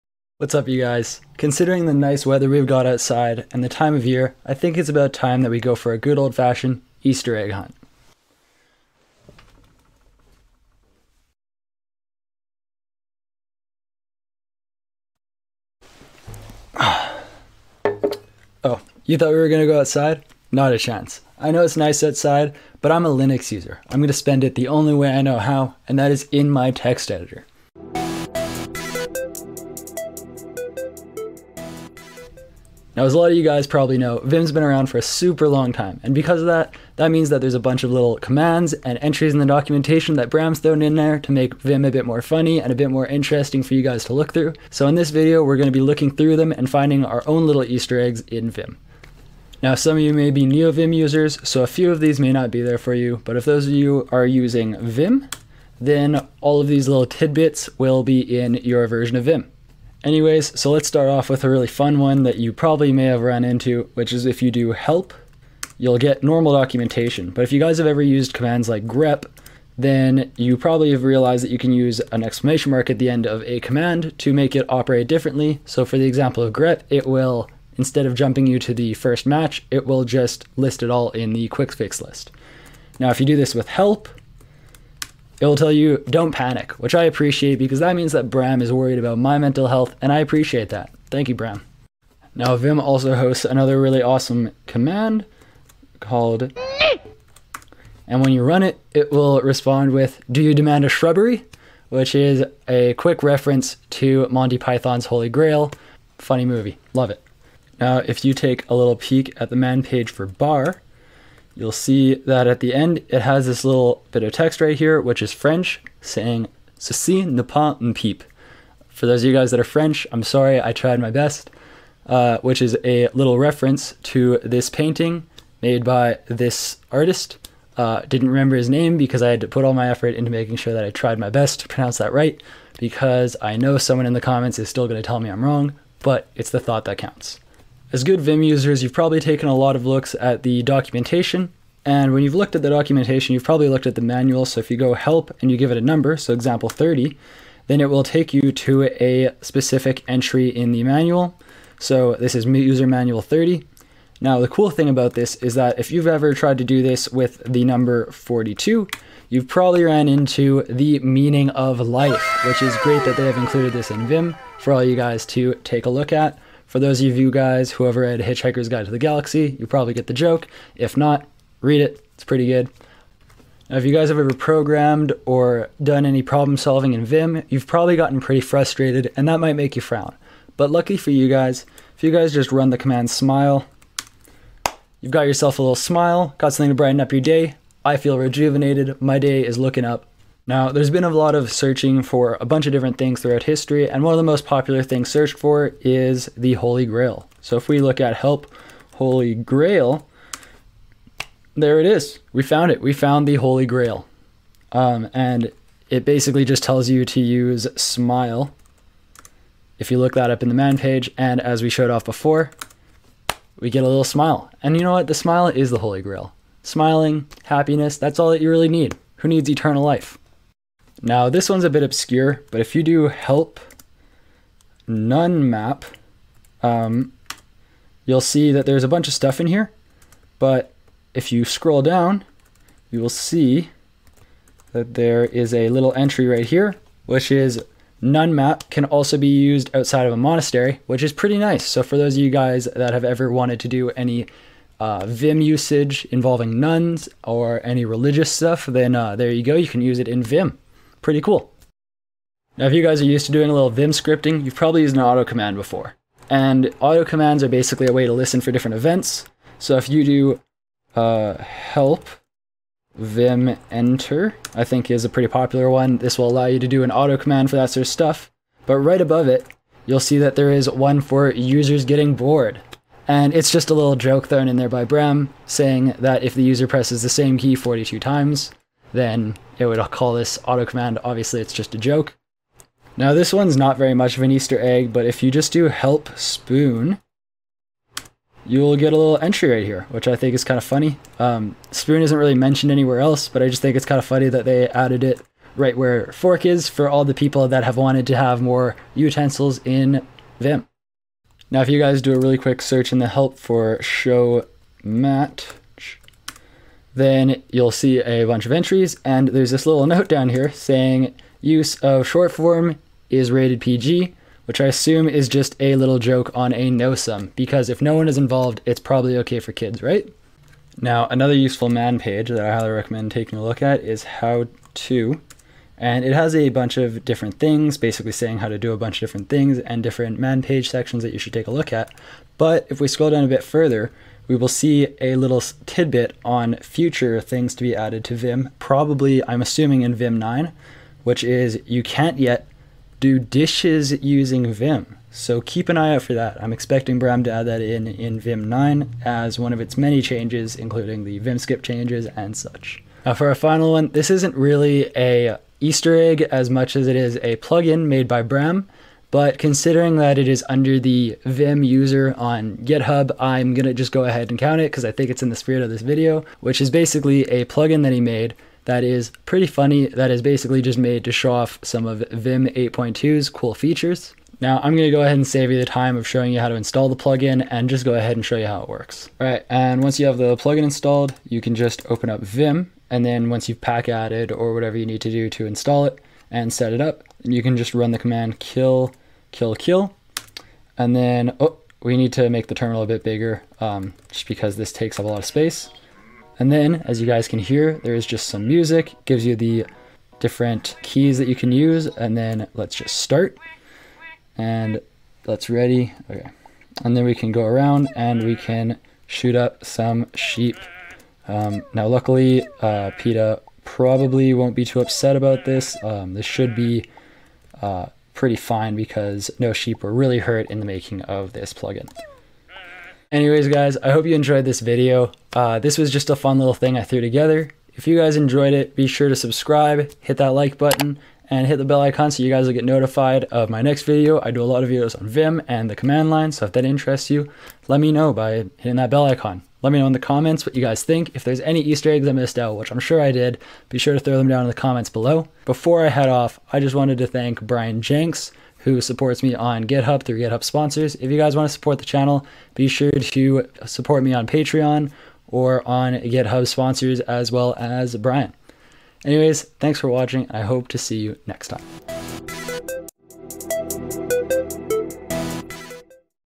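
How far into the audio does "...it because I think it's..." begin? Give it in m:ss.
6:04.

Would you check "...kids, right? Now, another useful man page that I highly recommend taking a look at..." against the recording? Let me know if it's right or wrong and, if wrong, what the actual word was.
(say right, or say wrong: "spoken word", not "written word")
right.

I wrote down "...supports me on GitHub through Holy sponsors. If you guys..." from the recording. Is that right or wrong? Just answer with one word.
wrong.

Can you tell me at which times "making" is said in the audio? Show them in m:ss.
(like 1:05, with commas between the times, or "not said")
2:10, 7:00.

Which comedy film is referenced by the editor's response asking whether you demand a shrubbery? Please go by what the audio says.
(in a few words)
Monty Python's Holy Grail.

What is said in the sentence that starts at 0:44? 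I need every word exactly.
So in this video, we're going to be looking through them and finding our own little Easter eggs in Vim.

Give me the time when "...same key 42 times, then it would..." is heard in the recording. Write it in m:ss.
4:37.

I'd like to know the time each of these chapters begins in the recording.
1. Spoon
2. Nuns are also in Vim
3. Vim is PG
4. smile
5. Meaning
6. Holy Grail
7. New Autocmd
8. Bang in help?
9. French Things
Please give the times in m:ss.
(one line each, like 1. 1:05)
1. 4:42
2. 3:40
3. 5:00
4. 2:53
5. 2:17
6. 3:10
7. 4:11
8. 1:00
9. 1:47.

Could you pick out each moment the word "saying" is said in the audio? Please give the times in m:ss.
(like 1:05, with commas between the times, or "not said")
1:56, 4:35, 5:10, 5:28.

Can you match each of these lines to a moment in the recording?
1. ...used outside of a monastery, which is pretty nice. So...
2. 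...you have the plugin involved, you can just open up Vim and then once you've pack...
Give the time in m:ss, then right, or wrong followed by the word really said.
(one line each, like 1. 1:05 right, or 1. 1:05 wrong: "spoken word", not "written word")
1. 3:59 right
2. 6:19 wrong: "installed", not "involved".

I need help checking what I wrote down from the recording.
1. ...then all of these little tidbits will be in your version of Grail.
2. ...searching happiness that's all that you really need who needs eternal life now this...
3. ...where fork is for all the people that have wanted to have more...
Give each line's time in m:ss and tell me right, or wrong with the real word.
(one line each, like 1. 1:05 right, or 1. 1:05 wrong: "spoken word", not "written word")
1. 0:55 wrong: "Vim", not "Grail"
2. 3:36 wrong: "smiling", not "searching"
3. 4:55 right.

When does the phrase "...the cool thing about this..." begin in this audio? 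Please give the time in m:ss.
2:34.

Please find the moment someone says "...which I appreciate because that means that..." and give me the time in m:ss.
1:26.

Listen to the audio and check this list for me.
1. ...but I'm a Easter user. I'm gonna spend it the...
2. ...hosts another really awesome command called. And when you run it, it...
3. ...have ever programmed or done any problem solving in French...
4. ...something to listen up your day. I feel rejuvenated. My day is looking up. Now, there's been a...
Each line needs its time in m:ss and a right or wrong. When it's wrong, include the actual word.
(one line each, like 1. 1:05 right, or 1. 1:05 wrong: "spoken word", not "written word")
1. 0:22 wrong: "Linux", not "Easter"
2. 1:33 right
3. 2:54 wrong: "Vim", not "French"
4. 3:06 wrong: "brighten", not "listen".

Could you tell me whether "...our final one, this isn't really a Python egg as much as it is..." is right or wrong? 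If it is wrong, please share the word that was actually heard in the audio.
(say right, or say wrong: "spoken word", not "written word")
wrong: "Easter", not "Python".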